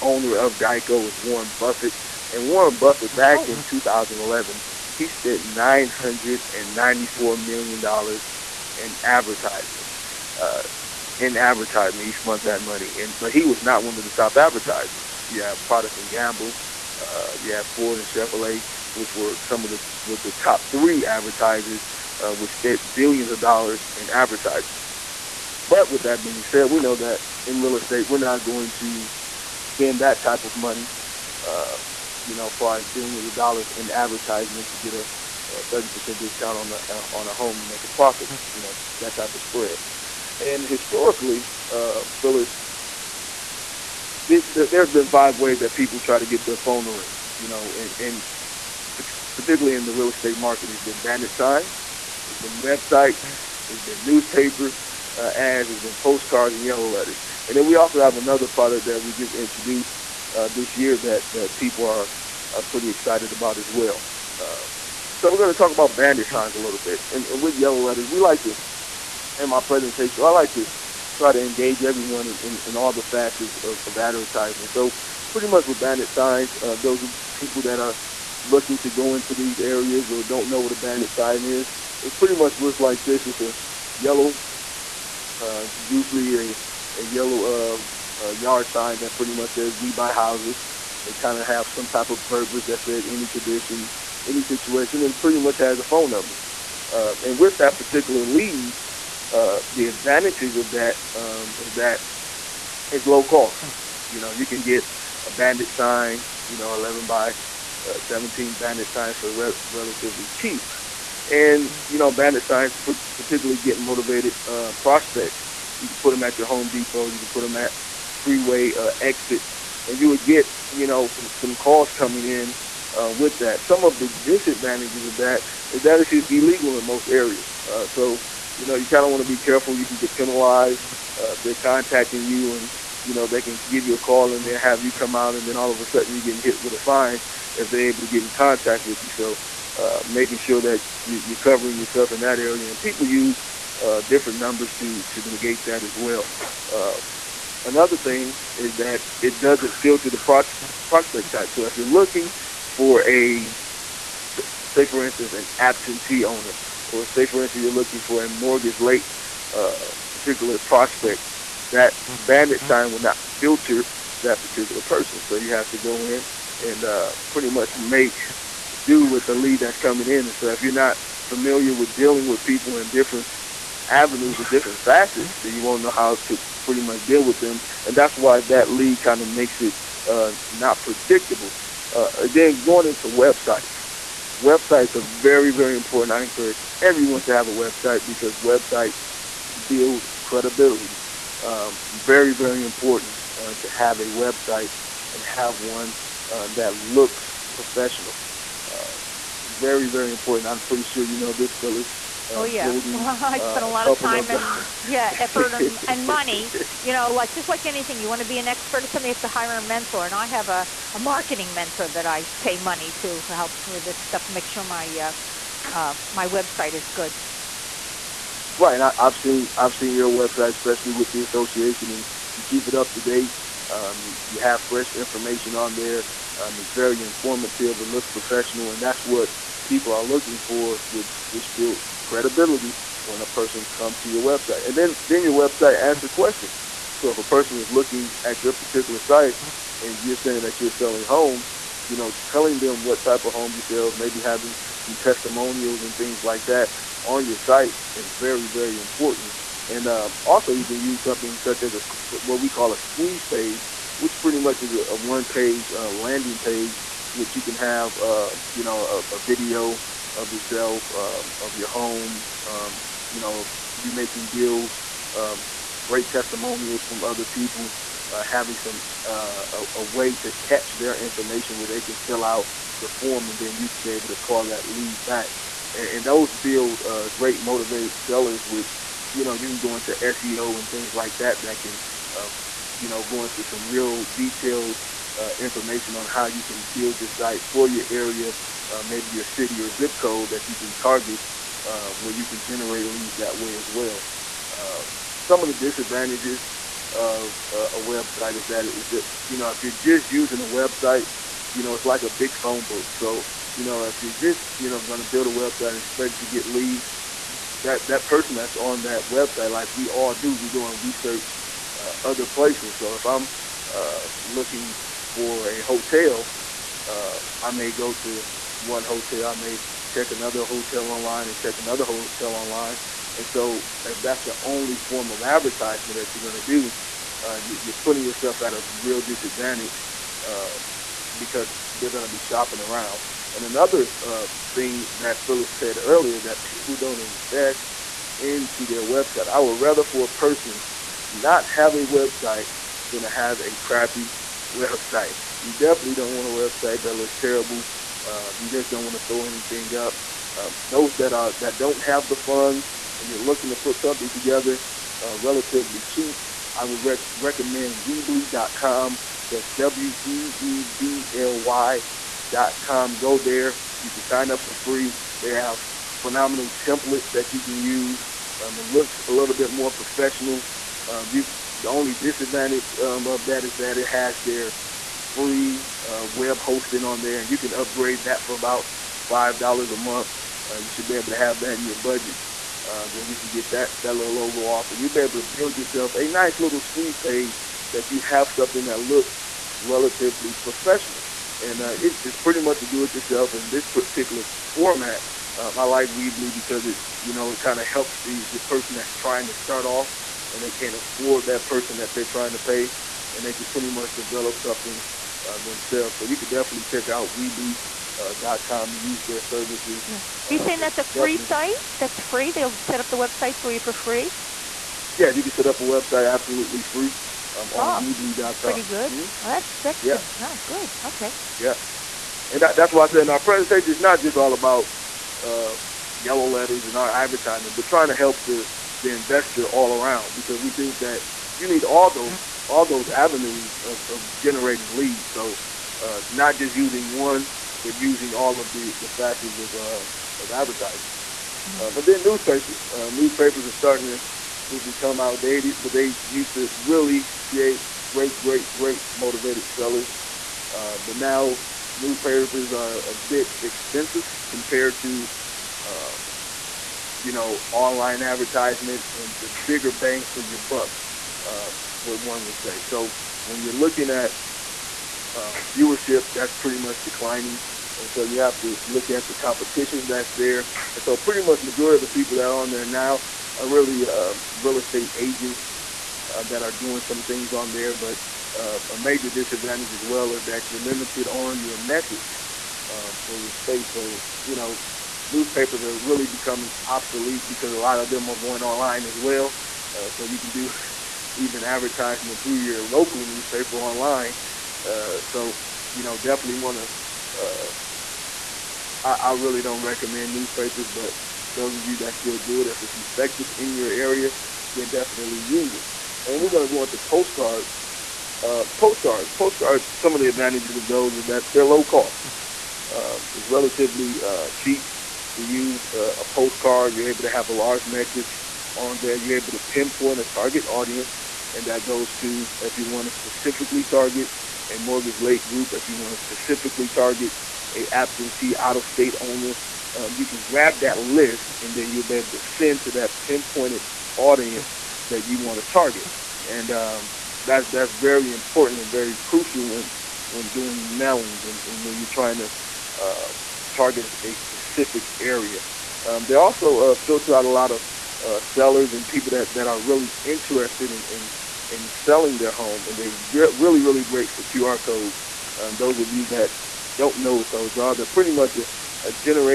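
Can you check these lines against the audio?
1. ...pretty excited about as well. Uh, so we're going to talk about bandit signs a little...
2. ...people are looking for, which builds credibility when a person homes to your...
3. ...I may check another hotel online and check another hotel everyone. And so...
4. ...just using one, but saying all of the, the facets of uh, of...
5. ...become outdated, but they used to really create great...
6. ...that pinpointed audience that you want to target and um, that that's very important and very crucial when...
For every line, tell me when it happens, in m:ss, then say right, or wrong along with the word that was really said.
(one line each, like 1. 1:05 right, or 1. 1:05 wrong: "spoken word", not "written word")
1. 1:02 right
2. 3:49 wrong: "comes", not "homes"
3. 5:19 wrong: "online", not "everyone"
4. 7:16 wrong: "using", not "saying"
5. 7:24 right
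6. 8:52 right.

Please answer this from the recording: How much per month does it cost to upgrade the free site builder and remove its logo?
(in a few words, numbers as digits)
5 dollars.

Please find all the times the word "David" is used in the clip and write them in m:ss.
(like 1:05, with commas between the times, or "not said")
not said.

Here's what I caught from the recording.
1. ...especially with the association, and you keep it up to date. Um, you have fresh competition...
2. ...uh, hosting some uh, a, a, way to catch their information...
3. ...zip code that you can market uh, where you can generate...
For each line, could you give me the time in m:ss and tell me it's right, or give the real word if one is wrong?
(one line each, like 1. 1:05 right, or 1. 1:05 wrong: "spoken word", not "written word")
1. 3:40 wrong: "information", not "competition"
2. 4:28 wrong: "having", not "hosting"
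3. 4:49 wrong: "target", not "market".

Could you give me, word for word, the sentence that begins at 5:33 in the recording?
And another uh, thing that Philip said earlier that people don't invest into their website.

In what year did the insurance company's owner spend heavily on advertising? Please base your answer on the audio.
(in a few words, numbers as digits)
2011.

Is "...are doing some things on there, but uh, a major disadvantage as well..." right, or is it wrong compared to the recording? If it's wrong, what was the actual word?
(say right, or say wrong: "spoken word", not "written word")
right.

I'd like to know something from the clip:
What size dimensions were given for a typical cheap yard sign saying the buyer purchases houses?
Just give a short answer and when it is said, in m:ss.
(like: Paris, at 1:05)
11 by 17, at 1:46.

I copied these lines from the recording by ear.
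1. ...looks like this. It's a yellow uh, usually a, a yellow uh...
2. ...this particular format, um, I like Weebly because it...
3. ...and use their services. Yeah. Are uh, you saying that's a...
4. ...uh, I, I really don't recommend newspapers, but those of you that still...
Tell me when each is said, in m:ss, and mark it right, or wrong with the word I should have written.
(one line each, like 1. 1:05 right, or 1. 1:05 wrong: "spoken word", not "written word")
1. 1:22 right
2. 6:33 right
3. 6:48 right
4. 8:17 right.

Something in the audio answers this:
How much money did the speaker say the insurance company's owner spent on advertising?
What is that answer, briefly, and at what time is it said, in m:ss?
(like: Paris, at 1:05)
994 million dollars, at 0:05.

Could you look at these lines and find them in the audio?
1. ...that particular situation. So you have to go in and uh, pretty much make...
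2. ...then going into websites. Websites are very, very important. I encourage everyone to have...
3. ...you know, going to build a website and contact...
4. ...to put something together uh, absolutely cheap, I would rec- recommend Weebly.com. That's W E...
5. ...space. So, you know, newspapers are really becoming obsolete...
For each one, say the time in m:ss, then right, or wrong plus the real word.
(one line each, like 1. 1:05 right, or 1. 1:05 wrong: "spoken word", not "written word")
1. 2:44 wrong: "person", not "situation"
2. 3:02 right
3. 5:04 wrong: "expect", not "contact"
4. 5:53 wrong: "relatively", not "absolutely"
5. 8:03 right.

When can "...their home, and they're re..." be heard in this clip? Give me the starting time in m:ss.
9:12.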